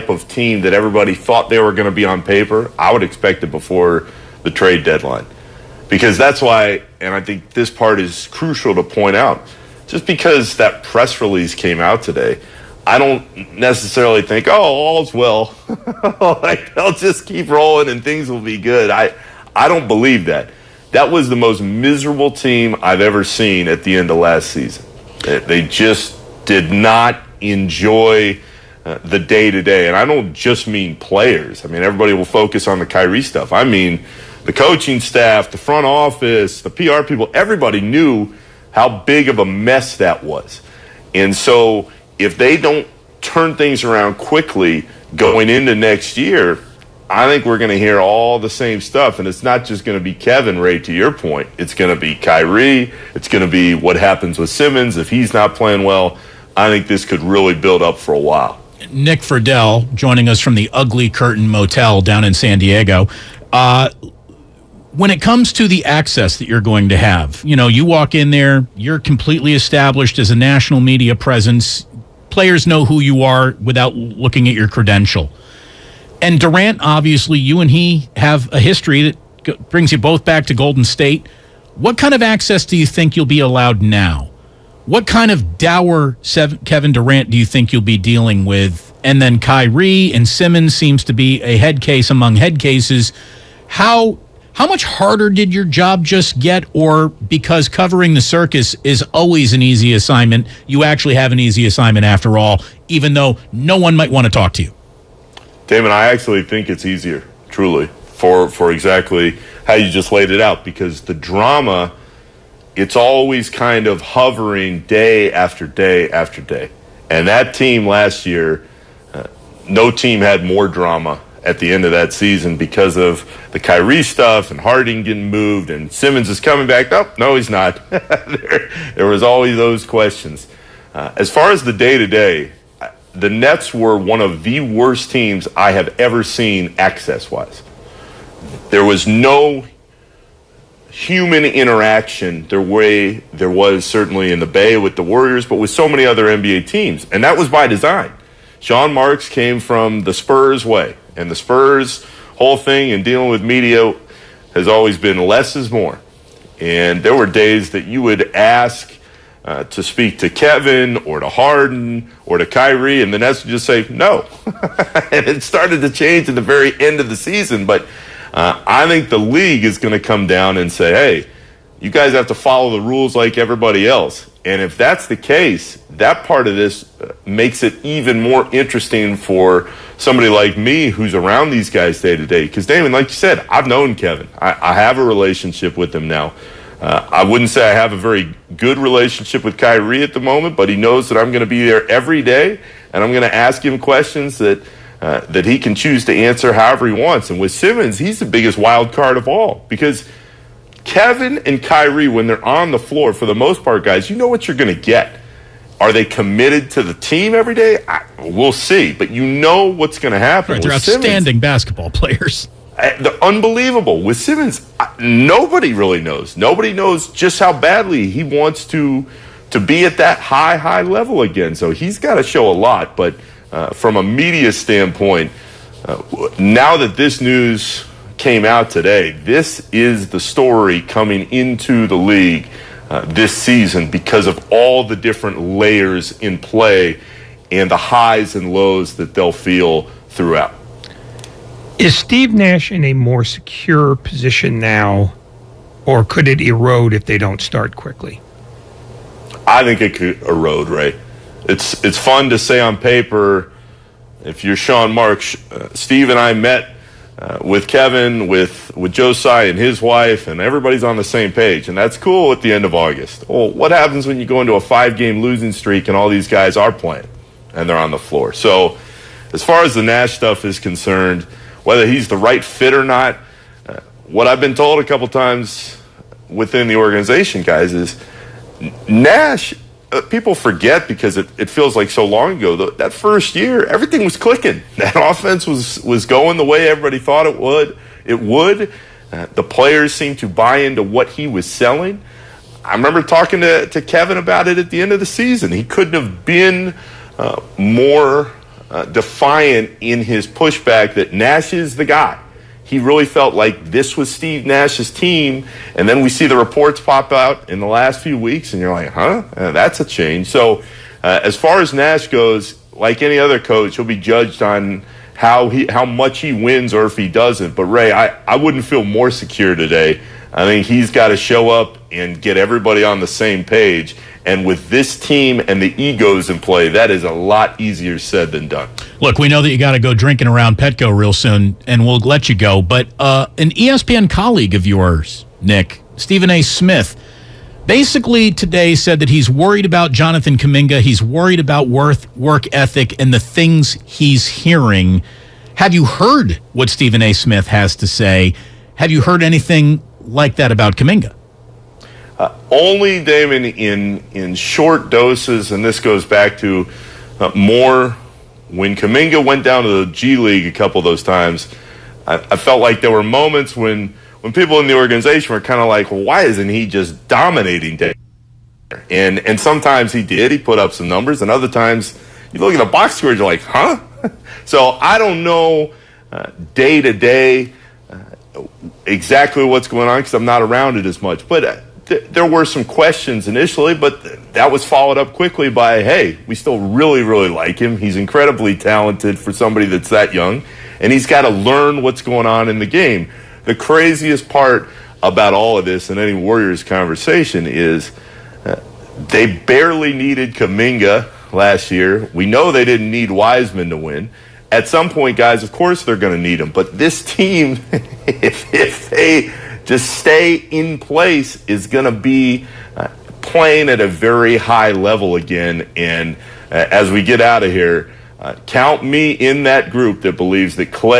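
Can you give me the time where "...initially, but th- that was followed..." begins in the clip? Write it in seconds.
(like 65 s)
383 s.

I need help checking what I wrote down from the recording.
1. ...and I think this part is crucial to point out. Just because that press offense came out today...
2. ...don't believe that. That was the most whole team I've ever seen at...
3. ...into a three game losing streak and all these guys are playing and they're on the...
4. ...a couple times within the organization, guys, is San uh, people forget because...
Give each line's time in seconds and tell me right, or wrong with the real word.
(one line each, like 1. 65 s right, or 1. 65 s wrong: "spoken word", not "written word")
1. 7 s wrong: "release", not "offense"
2. 19 s wrong: "miserable", not "whole"
3. 264 s wrong: "five", not "three"
4. 274 s wrong: "Nash", not "San".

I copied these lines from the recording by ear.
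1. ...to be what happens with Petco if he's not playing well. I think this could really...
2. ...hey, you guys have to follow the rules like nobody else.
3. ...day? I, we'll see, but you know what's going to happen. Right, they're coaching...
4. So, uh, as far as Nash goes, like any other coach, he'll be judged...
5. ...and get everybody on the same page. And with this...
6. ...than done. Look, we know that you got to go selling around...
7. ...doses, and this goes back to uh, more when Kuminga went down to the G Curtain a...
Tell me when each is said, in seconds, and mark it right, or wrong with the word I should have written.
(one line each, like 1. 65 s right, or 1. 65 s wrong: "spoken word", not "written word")
1. 53 s wrong: "Simmons", not "Petco"
2. 170 s wrong: "everybody", not "nobody"
3. 207 s wrong: "outstanding", not "coaching"
4. 310 s right
5. 321 s right
6. 328 s wrong: "drinking", not "selling"
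7. 354 s wrong: "League", not "Curtain".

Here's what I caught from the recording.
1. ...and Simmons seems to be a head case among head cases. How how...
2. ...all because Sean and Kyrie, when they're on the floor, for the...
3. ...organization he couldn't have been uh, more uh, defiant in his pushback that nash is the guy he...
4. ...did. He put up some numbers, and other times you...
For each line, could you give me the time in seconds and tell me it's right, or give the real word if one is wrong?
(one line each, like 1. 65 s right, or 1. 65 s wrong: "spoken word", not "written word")
1. 90 s right
2. 199 s wrong: "Kevin", not "Sean"
3. 295 s wrong: "season", not "organization"
4. 370 s right.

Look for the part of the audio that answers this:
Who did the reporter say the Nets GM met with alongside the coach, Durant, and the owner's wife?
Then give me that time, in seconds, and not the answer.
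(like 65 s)
258 s.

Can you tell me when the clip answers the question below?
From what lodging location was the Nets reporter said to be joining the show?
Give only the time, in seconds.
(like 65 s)
60 s.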